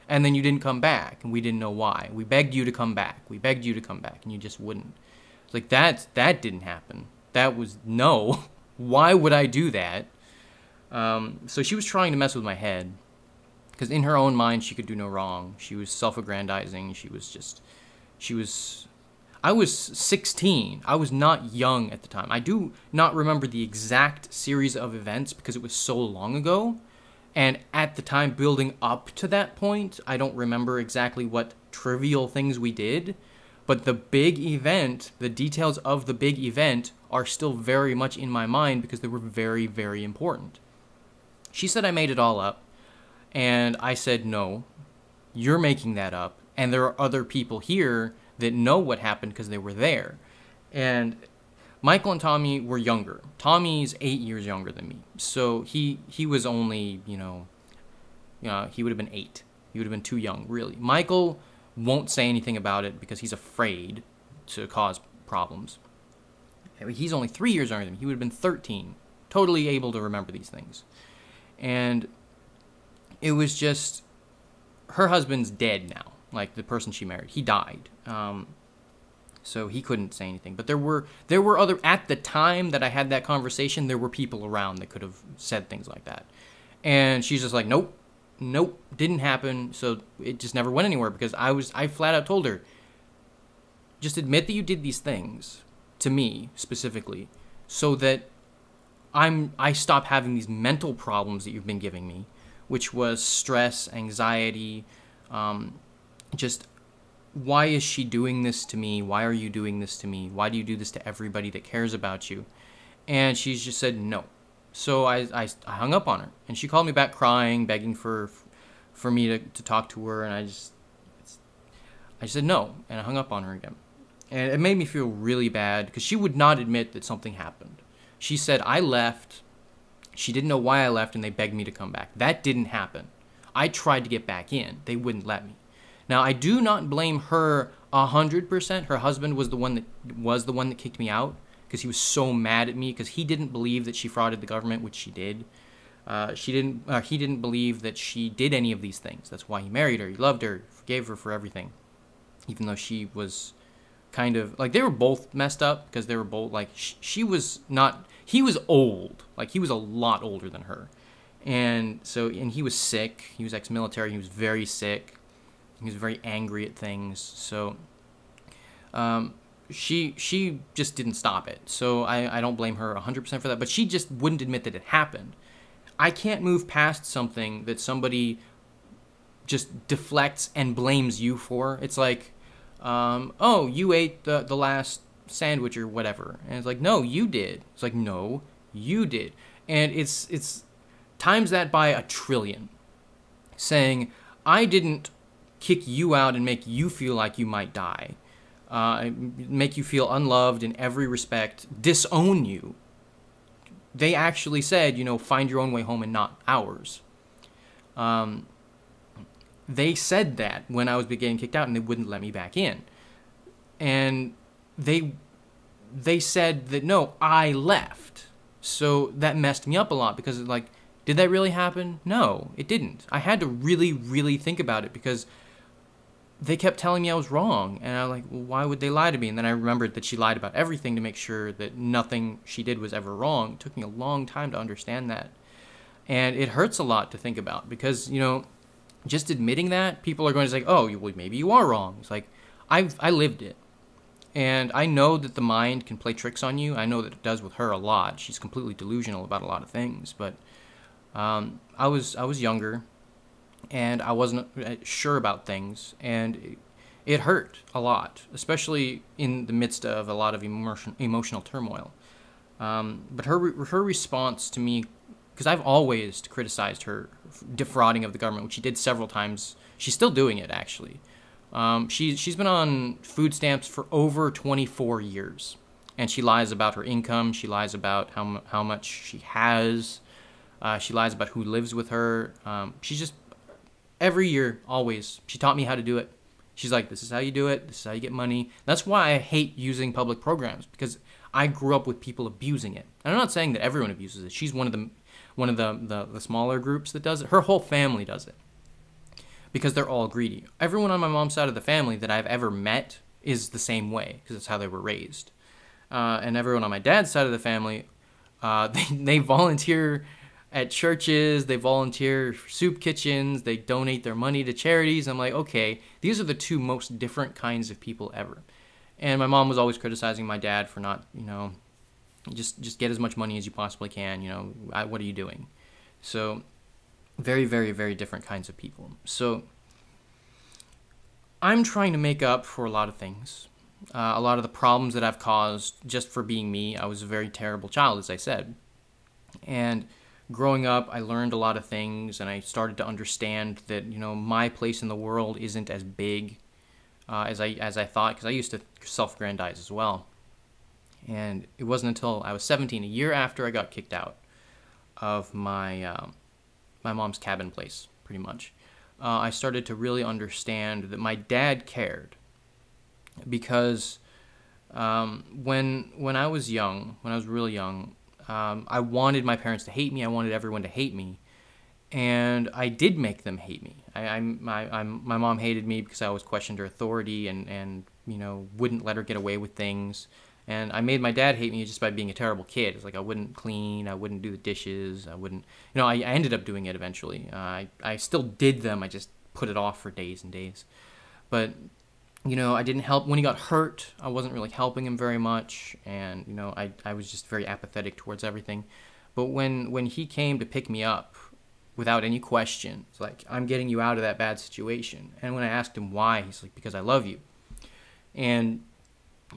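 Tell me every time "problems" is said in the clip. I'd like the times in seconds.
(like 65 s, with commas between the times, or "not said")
65 s, 100 s, 334 s.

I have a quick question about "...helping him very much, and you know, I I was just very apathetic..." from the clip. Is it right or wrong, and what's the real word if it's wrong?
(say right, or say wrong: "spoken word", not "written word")
right.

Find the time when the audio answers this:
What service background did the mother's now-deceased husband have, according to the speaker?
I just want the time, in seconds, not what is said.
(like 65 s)
163 s.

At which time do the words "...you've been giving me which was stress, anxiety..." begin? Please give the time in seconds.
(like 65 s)
101 s.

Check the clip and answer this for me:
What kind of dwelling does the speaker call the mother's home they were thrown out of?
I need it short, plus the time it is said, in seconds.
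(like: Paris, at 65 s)
cabin, at 357 s.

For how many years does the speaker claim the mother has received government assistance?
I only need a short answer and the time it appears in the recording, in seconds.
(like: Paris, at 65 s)
24, at 274 s.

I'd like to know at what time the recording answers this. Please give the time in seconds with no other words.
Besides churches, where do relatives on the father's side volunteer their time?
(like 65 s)
312 s.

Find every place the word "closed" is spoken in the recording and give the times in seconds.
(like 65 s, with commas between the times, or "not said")
not said.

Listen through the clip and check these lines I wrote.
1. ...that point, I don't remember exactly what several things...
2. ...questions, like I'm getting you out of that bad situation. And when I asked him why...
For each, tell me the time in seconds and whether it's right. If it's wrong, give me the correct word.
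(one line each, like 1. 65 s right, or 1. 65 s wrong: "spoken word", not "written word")
1. 29 s wrong: "trivial", not "several"
2. 402 s right.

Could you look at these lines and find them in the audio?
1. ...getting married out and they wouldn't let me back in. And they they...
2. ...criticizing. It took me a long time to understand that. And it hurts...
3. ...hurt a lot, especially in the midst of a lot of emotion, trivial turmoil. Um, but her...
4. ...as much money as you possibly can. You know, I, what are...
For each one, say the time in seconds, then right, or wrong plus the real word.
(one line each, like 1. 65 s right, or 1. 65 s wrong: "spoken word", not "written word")
1. 211 s wrong: "kicked", not "married"
2. 233 s wrong: "wrong", not "criticizing"
3. 257 s wrong: "emotional", not "trivial"
4. 322 s right.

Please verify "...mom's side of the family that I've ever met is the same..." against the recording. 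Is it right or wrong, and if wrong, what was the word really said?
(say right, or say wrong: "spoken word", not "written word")
right.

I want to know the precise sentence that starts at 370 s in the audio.
I wanted everyone to hate me, and I did make them hate me.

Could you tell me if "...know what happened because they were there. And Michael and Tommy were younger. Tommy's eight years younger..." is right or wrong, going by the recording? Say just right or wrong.
right.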